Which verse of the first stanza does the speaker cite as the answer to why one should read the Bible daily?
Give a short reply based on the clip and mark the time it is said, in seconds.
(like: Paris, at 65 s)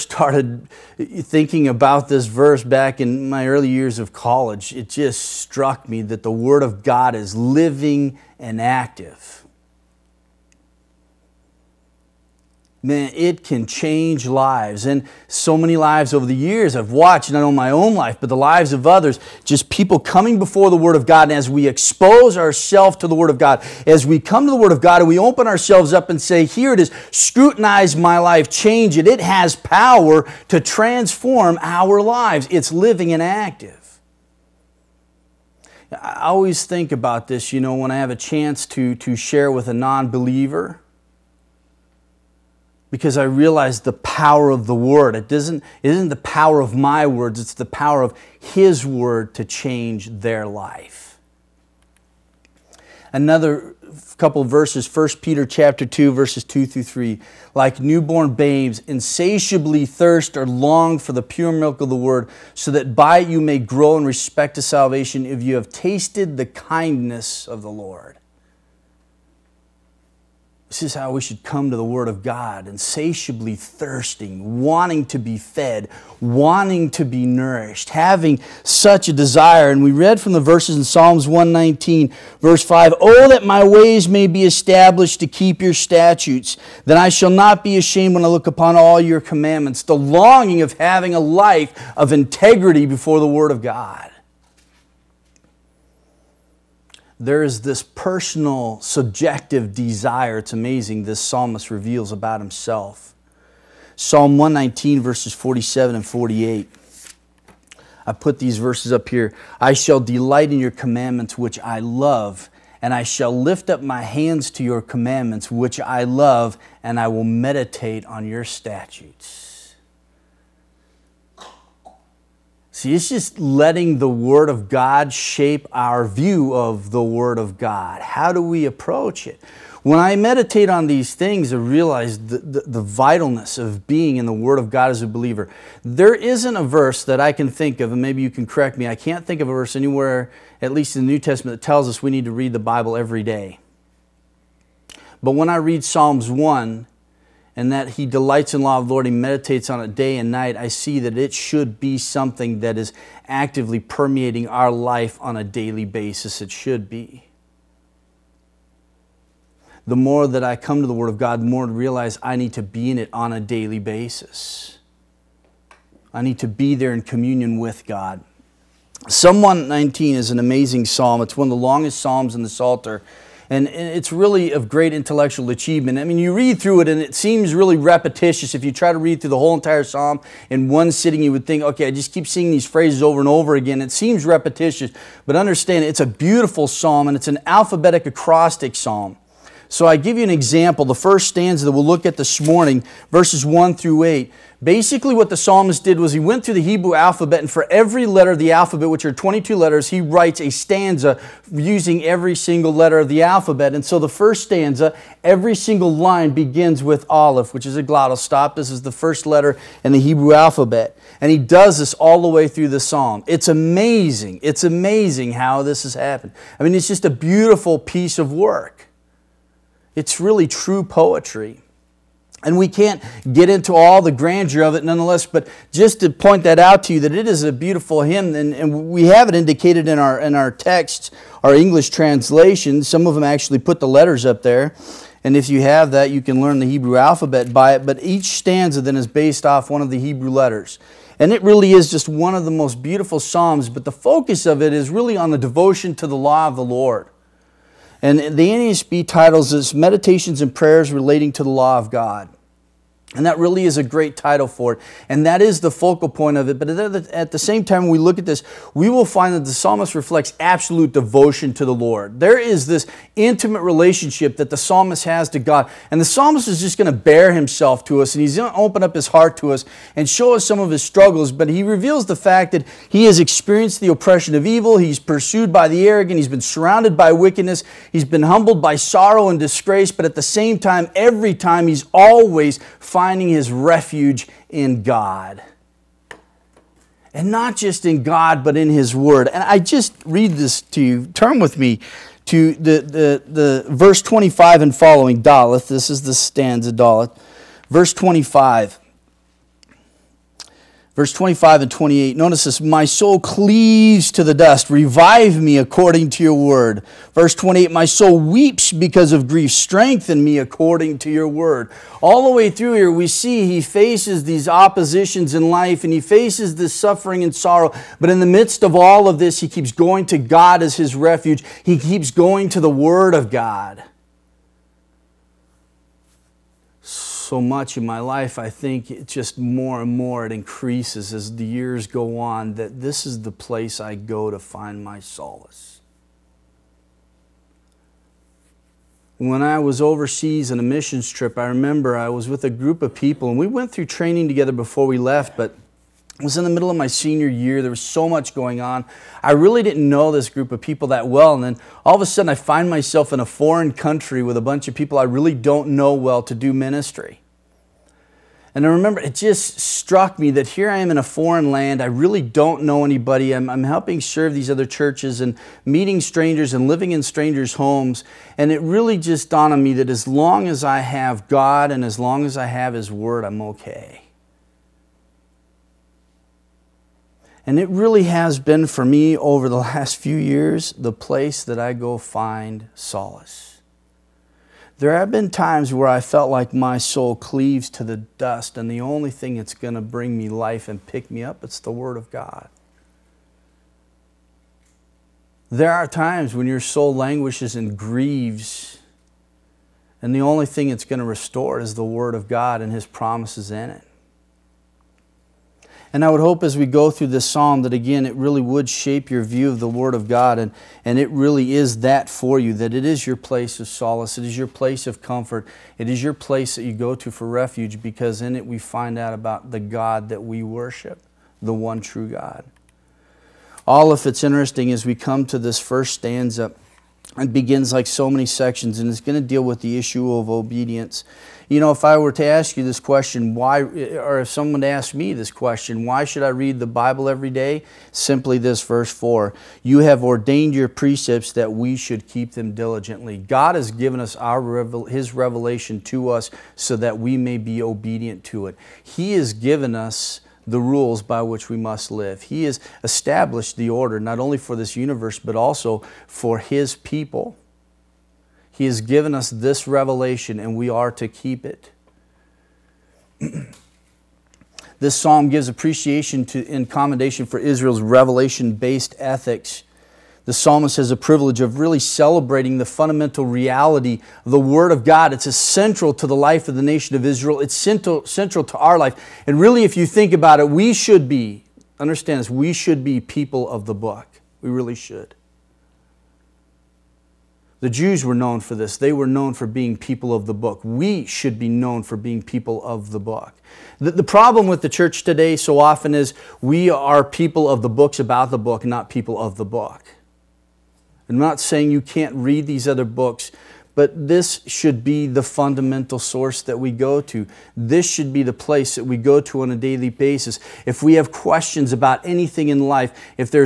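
Verse 4, at 438 s.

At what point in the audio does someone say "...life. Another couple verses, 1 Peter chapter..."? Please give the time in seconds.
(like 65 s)
50 s.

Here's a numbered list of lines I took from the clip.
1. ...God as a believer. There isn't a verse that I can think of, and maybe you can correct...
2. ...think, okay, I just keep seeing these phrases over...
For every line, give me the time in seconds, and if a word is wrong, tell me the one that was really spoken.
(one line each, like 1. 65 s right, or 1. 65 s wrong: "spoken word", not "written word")
1. 134 s right
2. 181 s right.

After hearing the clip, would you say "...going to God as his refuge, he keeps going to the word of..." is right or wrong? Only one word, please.
right.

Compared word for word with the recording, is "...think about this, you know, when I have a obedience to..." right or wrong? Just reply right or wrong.
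wrong.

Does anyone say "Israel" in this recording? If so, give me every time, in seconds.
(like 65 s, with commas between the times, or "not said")
467 s, 477 s.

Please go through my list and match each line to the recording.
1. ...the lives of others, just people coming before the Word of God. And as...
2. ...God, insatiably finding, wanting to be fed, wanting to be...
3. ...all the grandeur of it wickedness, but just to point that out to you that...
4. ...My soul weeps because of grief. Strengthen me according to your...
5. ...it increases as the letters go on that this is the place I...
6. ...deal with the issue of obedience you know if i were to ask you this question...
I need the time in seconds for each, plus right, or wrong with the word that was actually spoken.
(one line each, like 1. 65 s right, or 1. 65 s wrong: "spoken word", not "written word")
1. 18 s right
2. 72 s wrong: "thirsting", not "finding"
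3. 223 s wrong: "nonetheless", not "wickedness"
4. 307 s right
5. 330 s wrong: "years", not "letters"
6. 429 s right.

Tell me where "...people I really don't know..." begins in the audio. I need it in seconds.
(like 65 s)
354 s.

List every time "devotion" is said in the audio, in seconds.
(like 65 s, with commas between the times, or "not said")
245 s, 260 s.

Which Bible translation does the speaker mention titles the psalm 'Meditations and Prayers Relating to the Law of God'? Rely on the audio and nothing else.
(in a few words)
NASB.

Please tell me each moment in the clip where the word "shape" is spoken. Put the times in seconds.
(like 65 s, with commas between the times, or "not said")
125 s, 408 s.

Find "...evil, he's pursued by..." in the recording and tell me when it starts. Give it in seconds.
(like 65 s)
274 s.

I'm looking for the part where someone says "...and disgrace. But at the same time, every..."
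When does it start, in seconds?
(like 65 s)
279 s.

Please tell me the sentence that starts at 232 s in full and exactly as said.
Some of them actually put the letters up there.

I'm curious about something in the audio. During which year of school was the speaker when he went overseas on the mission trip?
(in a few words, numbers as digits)
Senior year.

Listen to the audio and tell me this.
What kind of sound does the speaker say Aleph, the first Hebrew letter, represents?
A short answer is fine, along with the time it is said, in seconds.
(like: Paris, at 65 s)
A glottal stop, at 207 s.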